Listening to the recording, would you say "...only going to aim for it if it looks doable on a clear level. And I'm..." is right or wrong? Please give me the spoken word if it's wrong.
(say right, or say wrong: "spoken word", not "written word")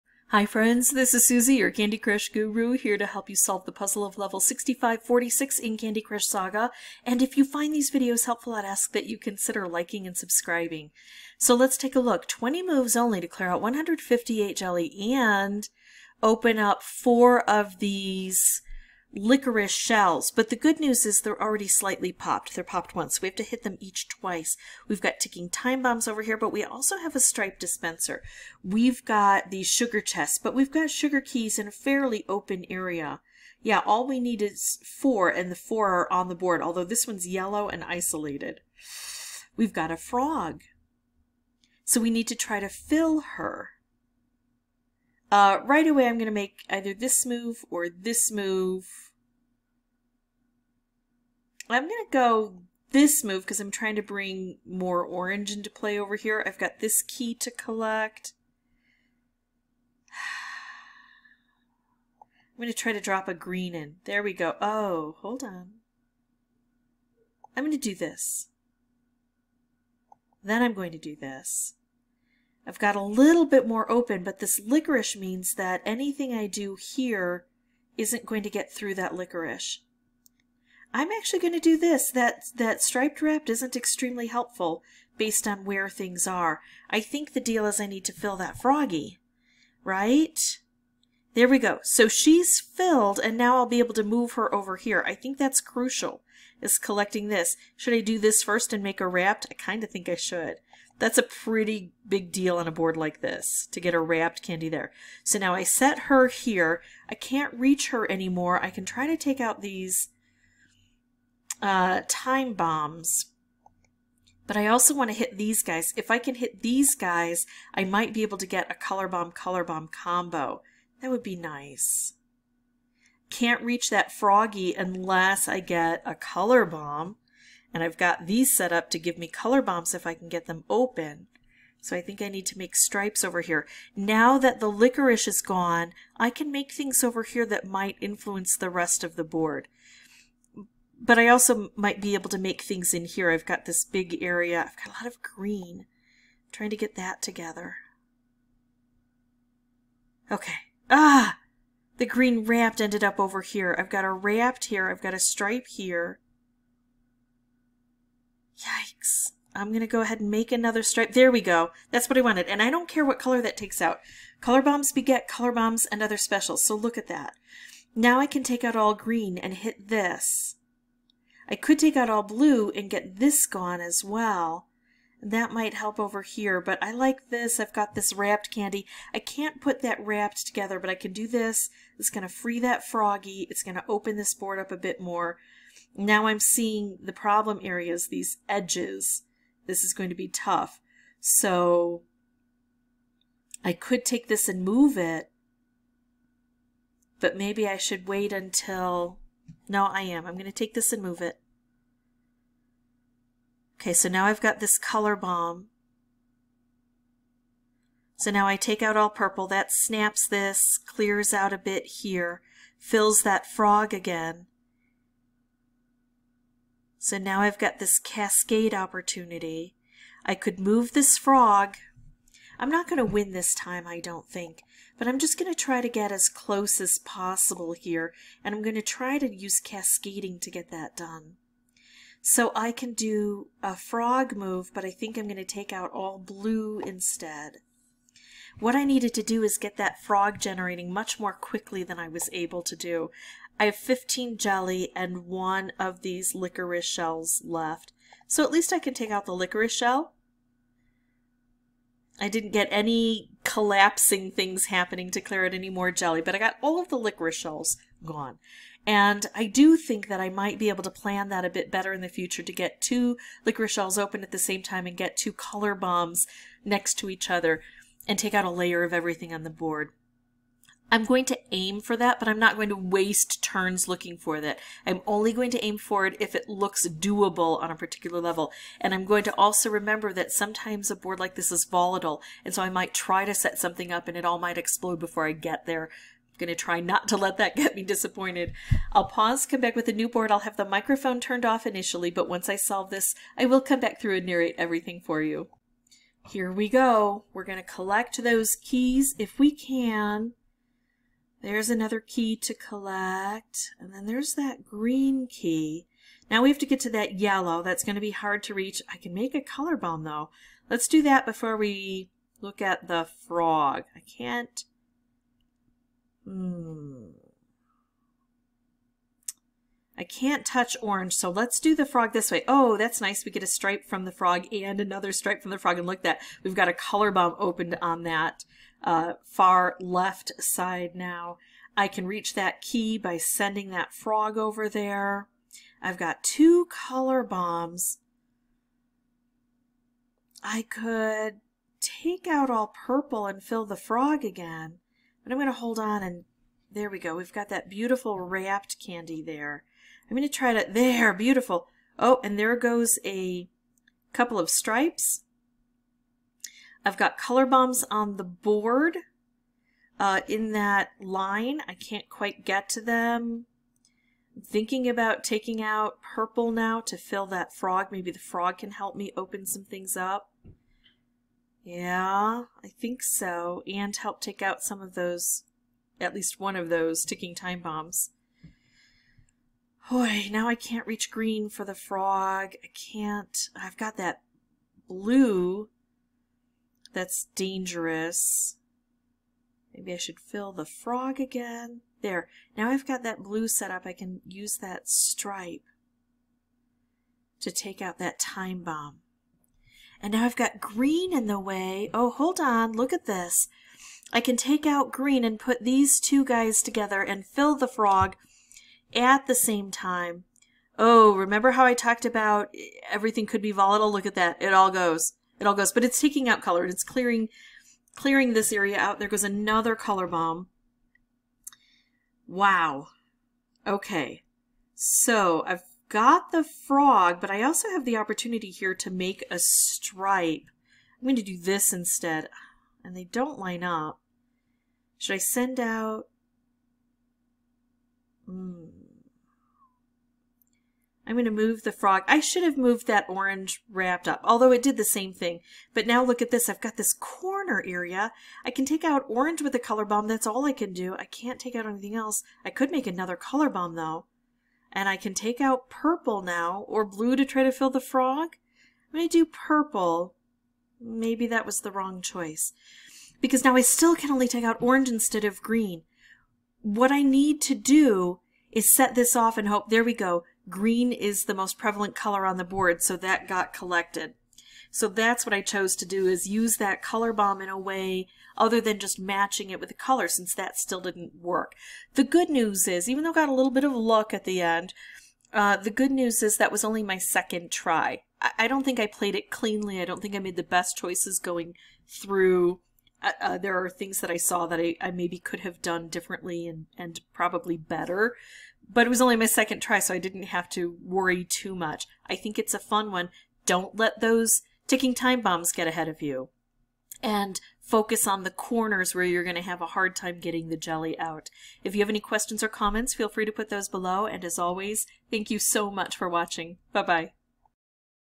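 wrong: "particular", not "clear".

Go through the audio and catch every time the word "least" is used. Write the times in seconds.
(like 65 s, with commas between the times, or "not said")
248 s, 376 s.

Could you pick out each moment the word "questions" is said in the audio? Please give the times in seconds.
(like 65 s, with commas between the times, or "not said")
511 s.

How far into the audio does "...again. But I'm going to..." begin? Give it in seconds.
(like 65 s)
344 s.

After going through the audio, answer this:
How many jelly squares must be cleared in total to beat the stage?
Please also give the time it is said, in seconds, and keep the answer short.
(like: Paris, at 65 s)
158, at 13 s.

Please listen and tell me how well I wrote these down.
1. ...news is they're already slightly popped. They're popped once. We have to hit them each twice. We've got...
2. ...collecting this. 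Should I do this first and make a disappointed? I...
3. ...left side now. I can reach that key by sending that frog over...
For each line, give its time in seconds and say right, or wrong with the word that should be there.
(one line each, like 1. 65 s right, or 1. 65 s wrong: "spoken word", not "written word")
1. 20 s right
2. 96 s wrong: "wrapped", not "disappointed"
3. 329 s right.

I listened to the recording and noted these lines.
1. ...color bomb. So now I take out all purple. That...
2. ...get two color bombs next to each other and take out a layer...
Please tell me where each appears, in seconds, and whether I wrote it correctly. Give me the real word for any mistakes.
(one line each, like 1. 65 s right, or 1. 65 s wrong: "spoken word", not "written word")
1. 204 s right
2. 264 s right.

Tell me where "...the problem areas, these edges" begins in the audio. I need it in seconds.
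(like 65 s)
187 s.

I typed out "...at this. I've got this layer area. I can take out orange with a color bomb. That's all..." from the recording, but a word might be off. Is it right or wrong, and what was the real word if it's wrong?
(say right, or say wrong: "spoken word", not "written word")
wrong: "corner", not "layer".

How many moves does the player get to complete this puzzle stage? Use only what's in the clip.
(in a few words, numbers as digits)
20.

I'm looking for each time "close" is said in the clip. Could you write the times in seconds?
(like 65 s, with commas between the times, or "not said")
226 s.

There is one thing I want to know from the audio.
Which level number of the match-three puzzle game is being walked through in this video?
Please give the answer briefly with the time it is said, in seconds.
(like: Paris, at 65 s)
6546, at 4 s.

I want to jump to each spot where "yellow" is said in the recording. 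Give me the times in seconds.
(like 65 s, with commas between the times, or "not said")
37 s, 307 s.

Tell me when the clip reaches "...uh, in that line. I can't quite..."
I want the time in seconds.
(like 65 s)
360 s.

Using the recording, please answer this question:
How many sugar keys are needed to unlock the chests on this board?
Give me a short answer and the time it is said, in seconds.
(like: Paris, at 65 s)
4, at 33 s.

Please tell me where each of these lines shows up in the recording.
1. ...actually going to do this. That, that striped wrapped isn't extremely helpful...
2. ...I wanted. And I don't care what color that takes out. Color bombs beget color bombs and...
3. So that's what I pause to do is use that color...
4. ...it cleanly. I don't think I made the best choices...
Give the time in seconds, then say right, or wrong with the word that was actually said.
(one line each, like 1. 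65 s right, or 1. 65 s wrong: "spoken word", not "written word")
1. 81 s right
2. 162 s right
3. 474 s wrong: "chose", not "pause"
4. 489 s right.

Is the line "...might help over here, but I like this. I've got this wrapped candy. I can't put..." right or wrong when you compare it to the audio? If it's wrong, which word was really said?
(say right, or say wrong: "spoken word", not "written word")
right.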